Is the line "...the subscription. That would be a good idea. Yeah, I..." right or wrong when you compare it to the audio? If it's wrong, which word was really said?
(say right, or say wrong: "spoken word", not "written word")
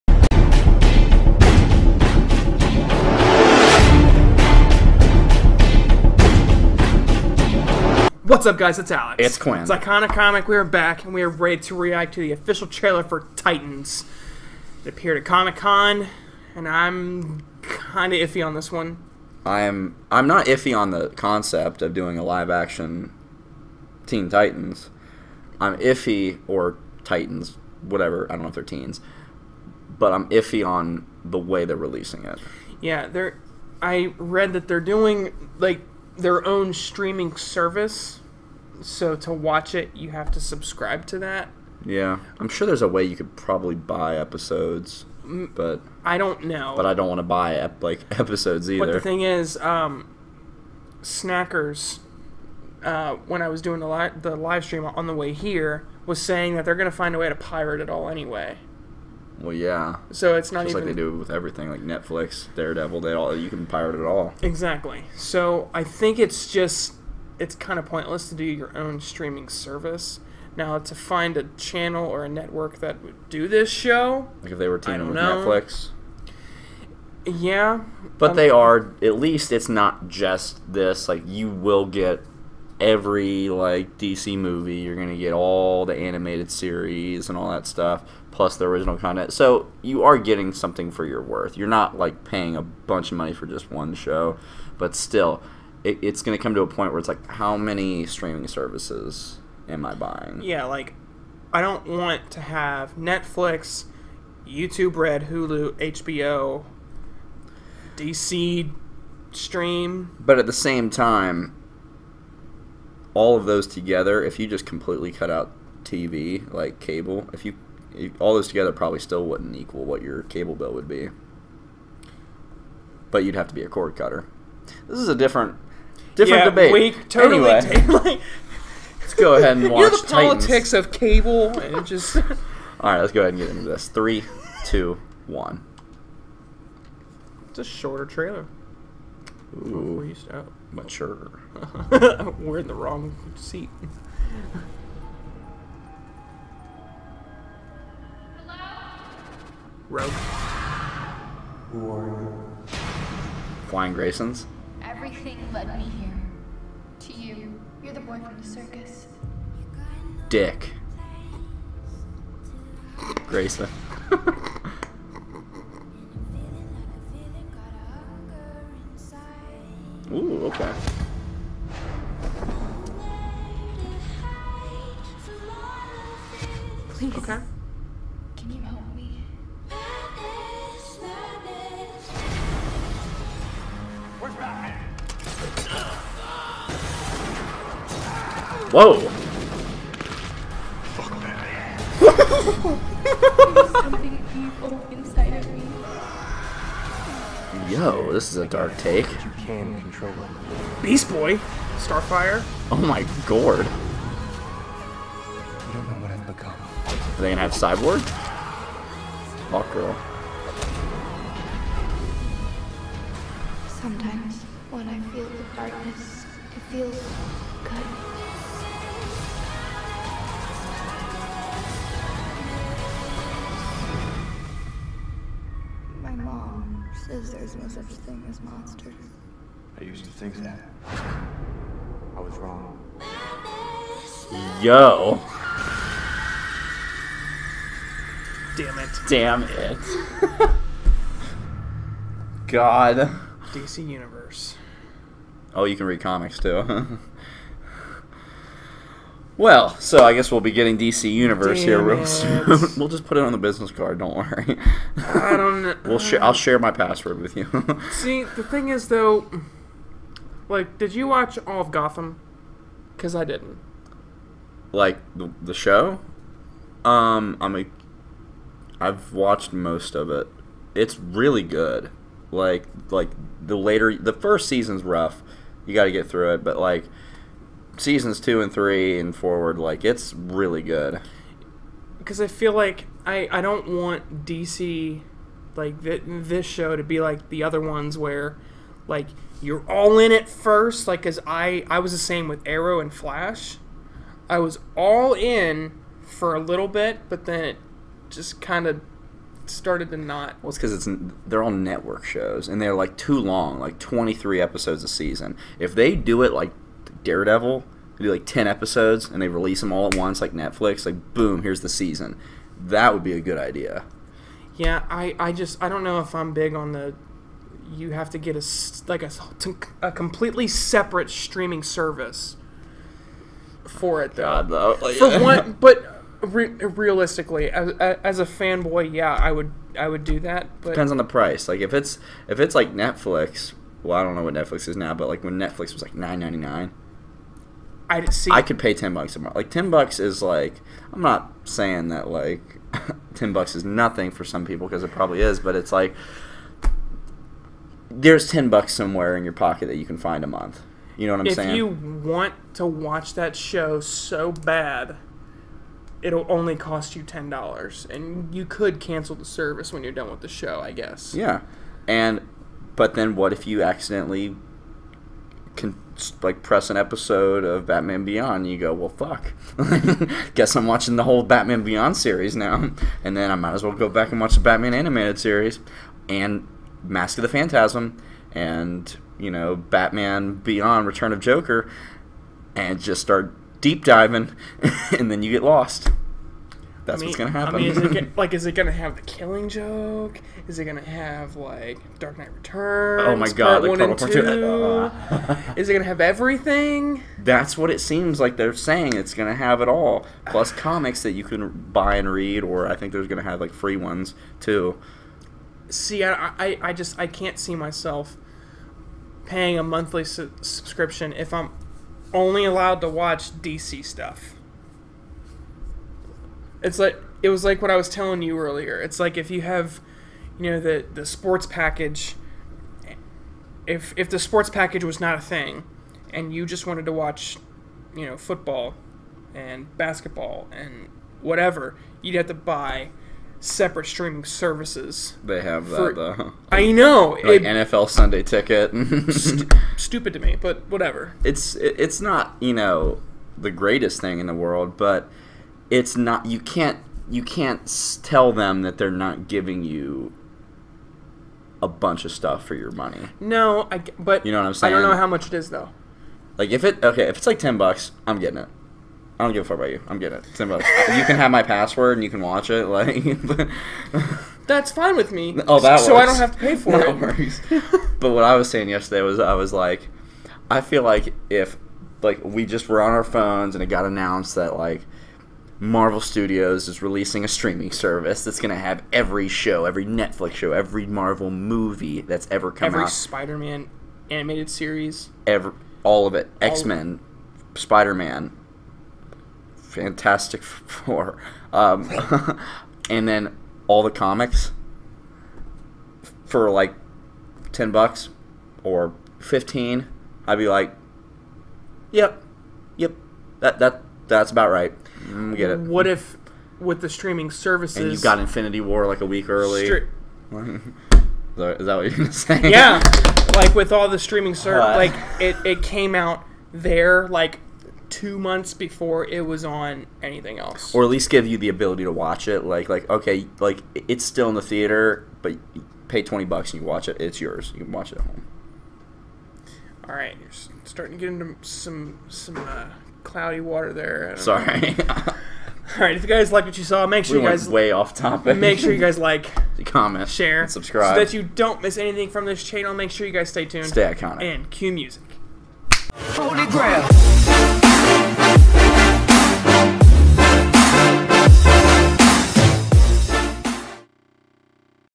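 wrong: "season", not "subscription".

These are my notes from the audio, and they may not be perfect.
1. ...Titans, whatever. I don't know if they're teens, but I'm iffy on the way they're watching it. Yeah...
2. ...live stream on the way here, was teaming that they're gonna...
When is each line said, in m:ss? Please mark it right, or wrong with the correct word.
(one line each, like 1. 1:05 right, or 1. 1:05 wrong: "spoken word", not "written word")
1. 0:27 wrong: "releasing", not "watching"
2. 0:54 wrong: "saying", not "teaming".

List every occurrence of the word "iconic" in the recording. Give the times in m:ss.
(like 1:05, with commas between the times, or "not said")
0:09, 9:03.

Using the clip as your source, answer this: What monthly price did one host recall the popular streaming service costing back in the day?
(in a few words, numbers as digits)
$9.99.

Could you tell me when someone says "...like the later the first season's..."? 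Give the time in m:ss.
4:32.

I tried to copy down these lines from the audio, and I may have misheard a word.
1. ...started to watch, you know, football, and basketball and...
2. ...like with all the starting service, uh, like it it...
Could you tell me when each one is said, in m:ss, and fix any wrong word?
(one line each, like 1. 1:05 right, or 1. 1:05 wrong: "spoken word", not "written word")
1. 7:06 wrong: "wanted", not "started"
2. 8:33 wrong: "streaming", not "starting".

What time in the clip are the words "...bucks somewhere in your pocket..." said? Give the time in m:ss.
5:48.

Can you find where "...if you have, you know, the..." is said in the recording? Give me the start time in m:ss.
6:59.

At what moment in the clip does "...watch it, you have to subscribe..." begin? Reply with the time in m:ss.
0:39.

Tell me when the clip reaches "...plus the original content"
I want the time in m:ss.
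1:28.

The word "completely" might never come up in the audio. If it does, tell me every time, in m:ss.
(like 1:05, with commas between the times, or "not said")
1:54, 5:19.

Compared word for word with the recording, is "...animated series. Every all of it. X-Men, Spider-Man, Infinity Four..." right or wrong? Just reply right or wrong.
wrong.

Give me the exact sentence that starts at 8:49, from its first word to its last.
All right, you're starting to get into some some uh, cloudy water there.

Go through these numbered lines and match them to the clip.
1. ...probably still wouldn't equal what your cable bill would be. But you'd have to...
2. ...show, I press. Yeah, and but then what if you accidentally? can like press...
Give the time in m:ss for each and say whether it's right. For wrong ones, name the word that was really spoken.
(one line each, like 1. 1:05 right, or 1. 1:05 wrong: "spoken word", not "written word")
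1. 1:58 right
2. 6:00 wrong: "guess", not "press".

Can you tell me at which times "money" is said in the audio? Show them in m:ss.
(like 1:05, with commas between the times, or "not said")
1:33, 7:32.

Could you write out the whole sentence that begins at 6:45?
See, I, I, I just I can't see myself paying a monthly su subscription if I'm only allowed to watch DC stuff.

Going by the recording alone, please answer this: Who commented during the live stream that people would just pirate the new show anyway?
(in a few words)
Snackers.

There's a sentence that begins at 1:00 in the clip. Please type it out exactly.
like they do with everything, like Netflix, Daredevil.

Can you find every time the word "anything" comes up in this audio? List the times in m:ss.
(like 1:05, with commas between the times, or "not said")
8:40, 9:01.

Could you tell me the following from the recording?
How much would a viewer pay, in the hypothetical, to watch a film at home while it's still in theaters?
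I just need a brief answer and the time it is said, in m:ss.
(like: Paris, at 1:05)
$20, at 8:46.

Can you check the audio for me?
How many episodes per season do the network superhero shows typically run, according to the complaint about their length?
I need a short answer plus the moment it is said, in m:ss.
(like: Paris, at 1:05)
23, at 5:03.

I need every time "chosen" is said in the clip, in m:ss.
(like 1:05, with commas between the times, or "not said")
not said.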